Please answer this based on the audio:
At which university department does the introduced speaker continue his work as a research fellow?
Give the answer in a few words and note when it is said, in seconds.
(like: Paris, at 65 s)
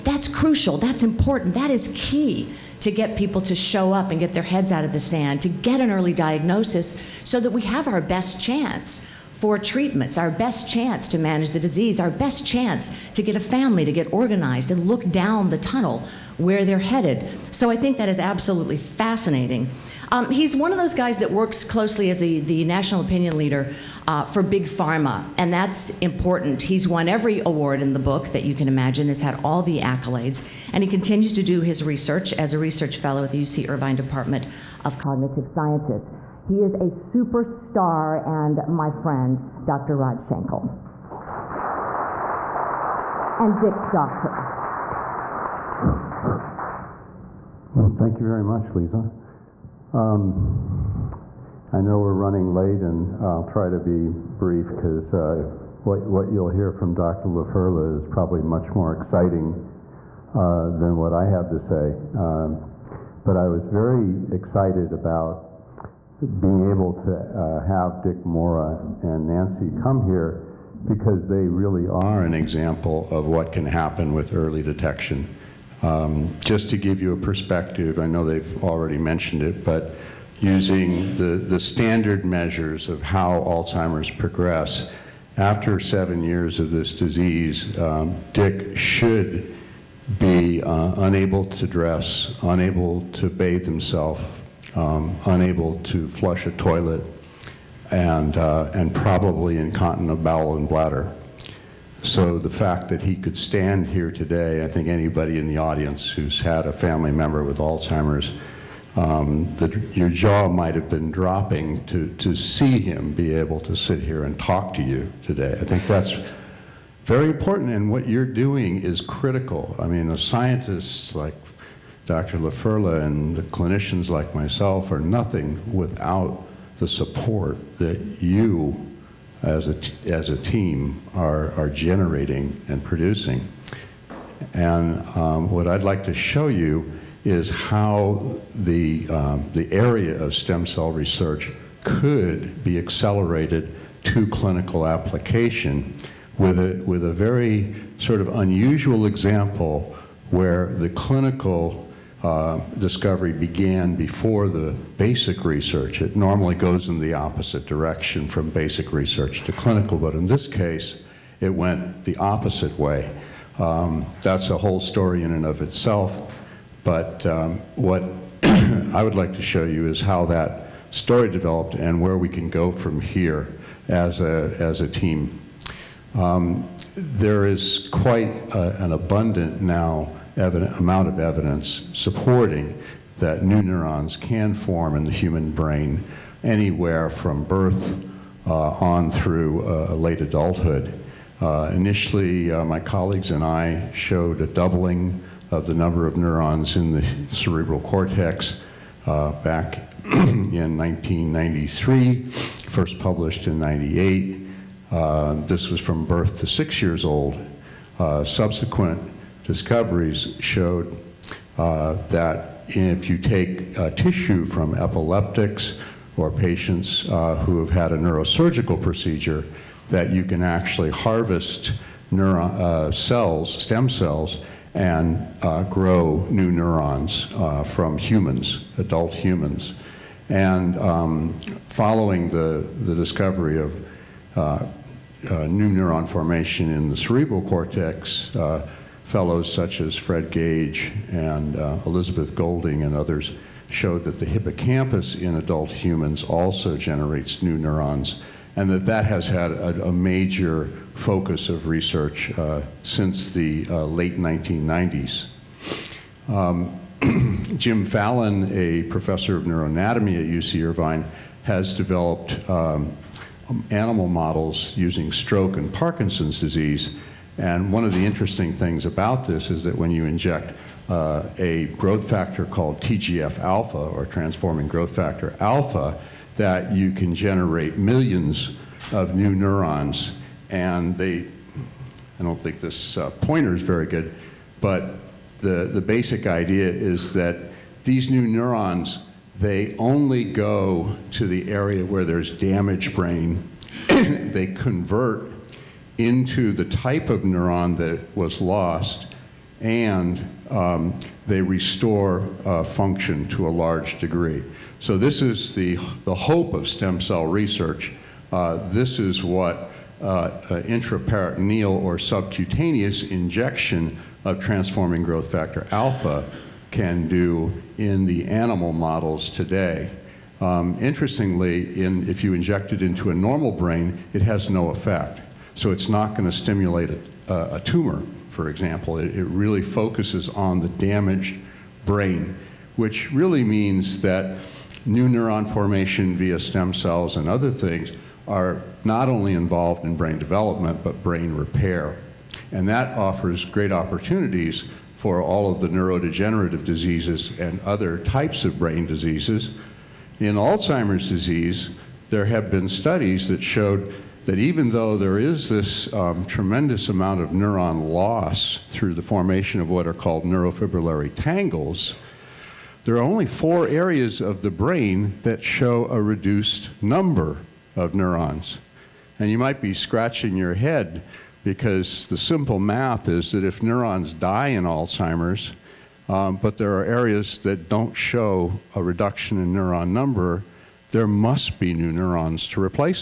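UC Irvine Department of Cognitive Sciences, at 33 s.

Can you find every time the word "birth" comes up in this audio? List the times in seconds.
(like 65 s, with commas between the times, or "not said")
187 s, 206 s.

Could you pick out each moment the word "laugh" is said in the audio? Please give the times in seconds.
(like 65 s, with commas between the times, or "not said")
not said.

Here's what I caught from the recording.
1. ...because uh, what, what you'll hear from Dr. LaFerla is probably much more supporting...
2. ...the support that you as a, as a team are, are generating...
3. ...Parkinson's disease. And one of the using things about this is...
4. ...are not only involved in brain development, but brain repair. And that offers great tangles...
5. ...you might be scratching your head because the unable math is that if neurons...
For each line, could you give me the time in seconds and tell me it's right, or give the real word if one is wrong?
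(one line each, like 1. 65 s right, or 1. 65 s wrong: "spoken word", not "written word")
1. 54 s wrong: "exciting", not "supporting"
2. 126 s right
3. 265 s wrong: "interesting", not "using"
4. 338 s wrong: "opportunities", not "tangles"
5. 369 s wrong: "simple", not "unable".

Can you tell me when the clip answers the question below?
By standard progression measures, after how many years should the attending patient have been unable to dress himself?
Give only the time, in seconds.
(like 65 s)
85 s.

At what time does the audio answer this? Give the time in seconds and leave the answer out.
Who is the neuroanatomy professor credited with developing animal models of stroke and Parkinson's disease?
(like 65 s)
257 s.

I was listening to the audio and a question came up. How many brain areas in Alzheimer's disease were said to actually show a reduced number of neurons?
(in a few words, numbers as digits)
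4.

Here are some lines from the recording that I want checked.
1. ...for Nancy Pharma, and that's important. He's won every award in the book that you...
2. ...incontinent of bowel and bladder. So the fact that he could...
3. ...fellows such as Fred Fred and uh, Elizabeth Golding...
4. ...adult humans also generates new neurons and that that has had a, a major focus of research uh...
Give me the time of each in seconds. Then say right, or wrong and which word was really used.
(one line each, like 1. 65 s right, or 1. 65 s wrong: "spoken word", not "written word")
1. 24 s wrong: "Big", not "Nancy"
2. 99 s right
3. 239 s wrong: "Gage", not "Fred"
4. 245 s right.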